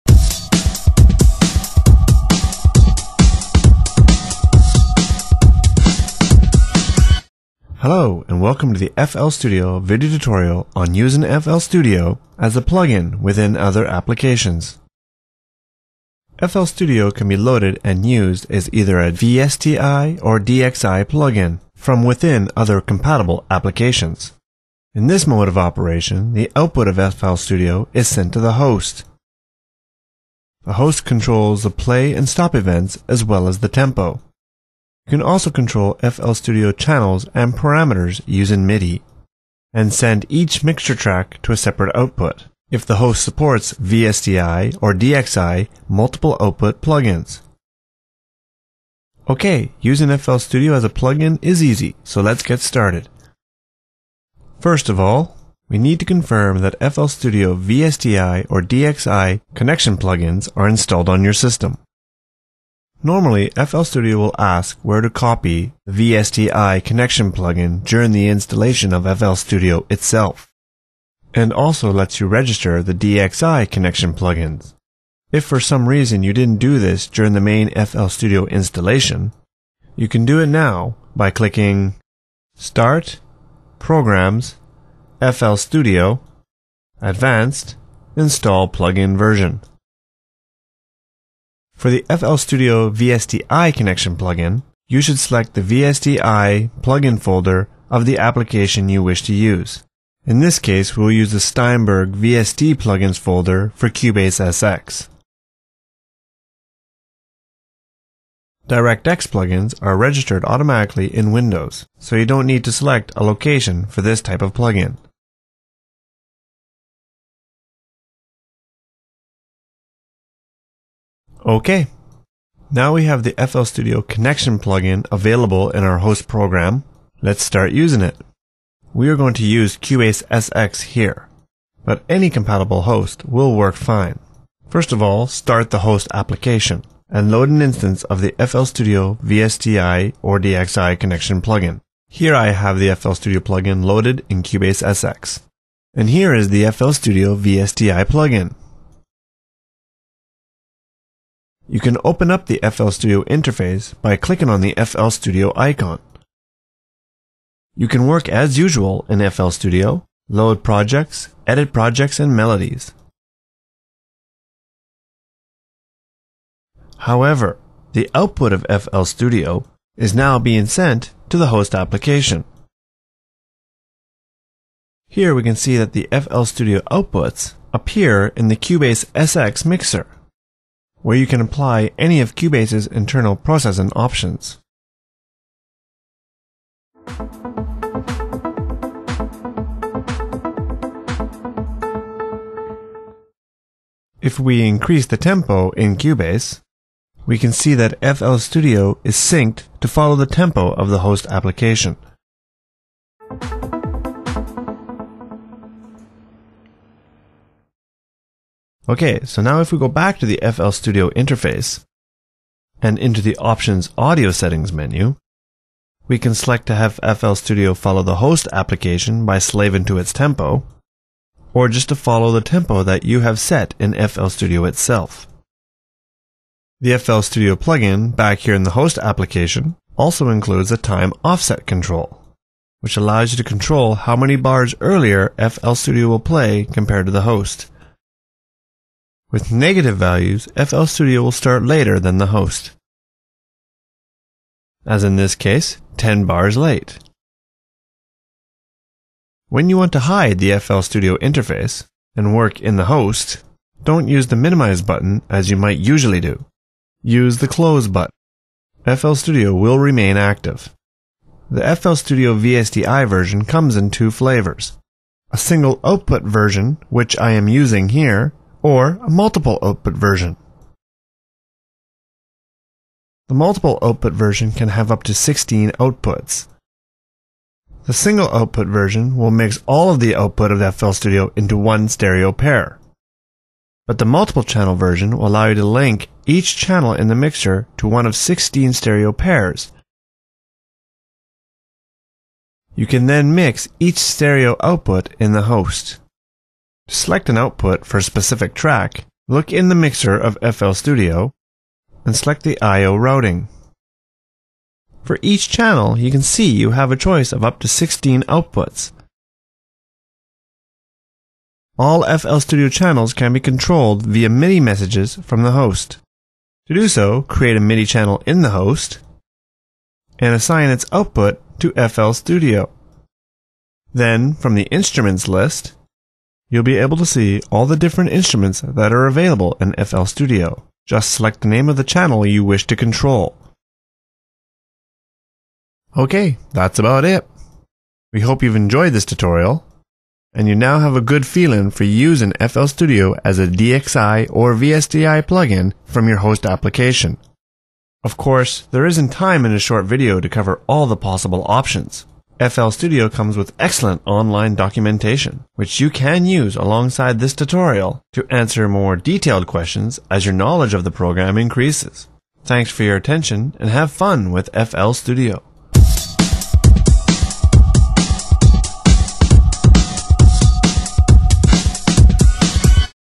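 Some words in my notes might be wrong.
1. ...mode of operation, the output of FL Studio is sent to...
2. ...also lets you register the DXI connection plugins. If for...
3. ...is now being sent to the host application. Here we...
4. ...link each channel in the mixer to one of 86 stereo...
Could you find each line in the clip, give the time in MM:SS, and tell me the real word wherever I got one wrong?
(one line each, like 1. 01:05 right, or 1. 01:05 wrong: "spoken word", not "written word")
1. 00:25 right
2. 01:11 right
3. 02:49 right
4. 04:45 wrong: "16", not "86".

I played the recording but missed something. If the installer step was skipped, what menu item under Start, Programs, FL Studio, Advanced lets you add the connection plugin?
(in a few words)
Install Plugin Version.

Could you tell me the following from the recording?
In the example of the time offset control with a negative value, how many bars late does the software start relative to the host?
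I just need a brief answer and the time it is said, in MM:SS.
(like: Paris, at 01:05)
10, at 04:05.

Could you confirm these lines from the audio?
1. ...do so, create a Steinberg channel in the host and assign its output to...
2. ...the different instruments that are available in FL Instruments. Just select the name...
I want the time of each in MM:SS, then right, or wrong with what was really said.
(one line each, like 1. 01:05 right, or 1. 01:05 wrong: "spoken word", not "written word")
1. 05:16 wrong: "MIDI", not "Steinberg"
2. 05:27 wrong: "Studio", not "Instruments".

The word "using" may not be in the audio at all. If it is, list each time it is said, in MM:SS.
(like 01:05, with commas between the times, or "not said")
00:10, 00:38, 00:49, 02:07, 04:27, 05:41.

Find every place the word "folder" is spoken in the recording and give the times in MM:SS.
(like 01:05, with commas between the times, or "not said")
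01:37, 01:43.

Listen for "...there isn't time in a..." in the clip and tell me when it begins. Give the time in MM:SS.
05:48.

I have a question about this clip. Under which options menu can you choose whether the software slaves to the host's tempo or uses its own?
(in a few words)
Audio Settings.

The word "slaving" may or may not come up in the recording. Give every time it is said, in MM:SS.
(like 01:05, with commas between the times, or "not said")
03:39.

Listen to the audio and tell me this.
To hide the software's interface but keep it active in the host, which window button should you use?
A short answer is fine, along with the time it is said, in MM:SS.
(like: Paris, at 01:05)
The close button, at 04:17.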